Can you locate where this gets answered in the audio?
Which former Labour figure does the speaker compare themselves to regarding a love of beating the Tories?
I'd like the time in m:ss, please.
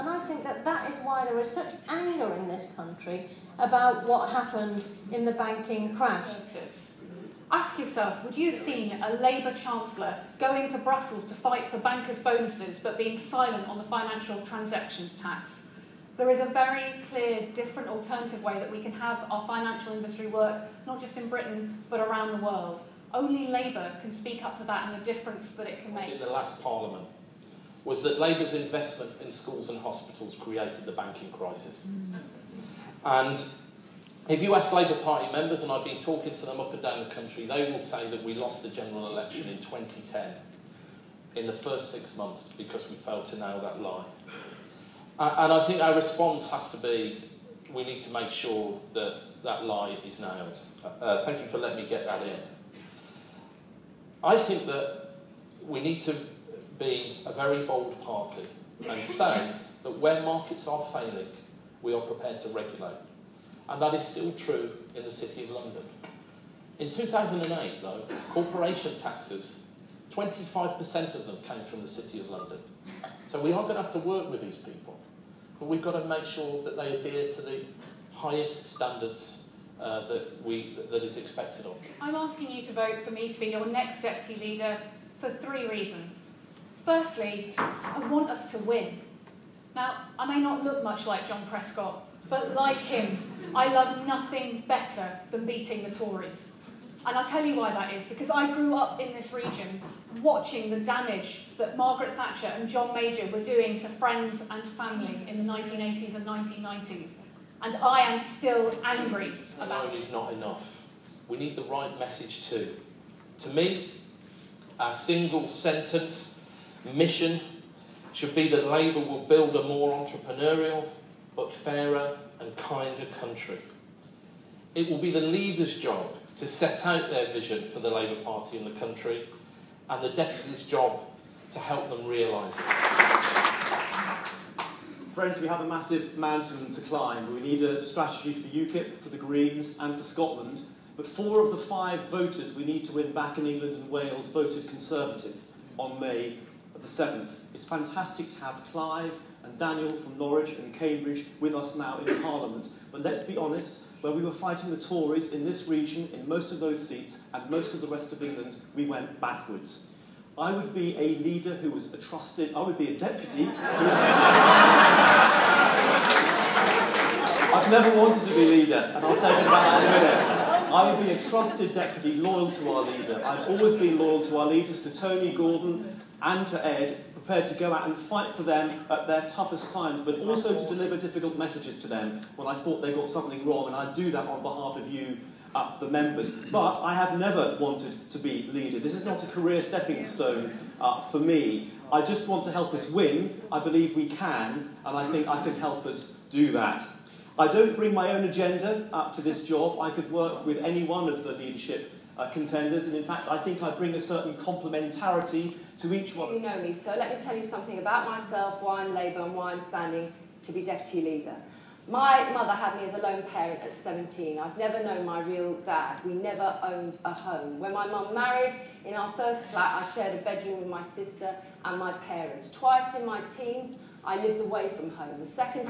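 1:31.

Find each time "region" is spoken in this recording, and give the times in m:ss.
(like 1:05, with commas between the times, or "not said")
1:39, 2:35.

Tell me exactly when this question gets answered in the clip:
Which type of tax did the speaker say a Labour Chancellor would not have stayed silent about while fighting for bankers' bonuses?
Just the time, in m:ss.
0:13.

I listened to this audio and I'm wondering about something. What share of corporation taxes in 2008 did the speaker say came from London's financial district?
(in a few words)
25%.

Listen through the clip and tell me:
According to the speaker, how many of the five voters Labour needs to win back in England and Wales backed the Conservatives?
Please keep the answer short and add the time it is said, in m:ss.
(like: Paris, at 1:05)
4, at 2:21.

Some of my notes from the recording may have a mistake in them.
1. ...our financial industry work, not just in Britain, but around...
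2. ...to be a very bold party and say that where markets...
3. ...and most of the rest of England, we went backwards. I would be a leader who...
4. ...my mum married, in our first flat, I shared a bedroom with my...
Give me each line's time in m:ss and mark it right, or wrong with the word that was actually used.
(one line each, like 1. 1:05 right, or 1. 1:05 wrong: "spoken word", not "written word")
1. 0:19 right
2. 0:55 right
3. 2:37 right
4. 3:37 right.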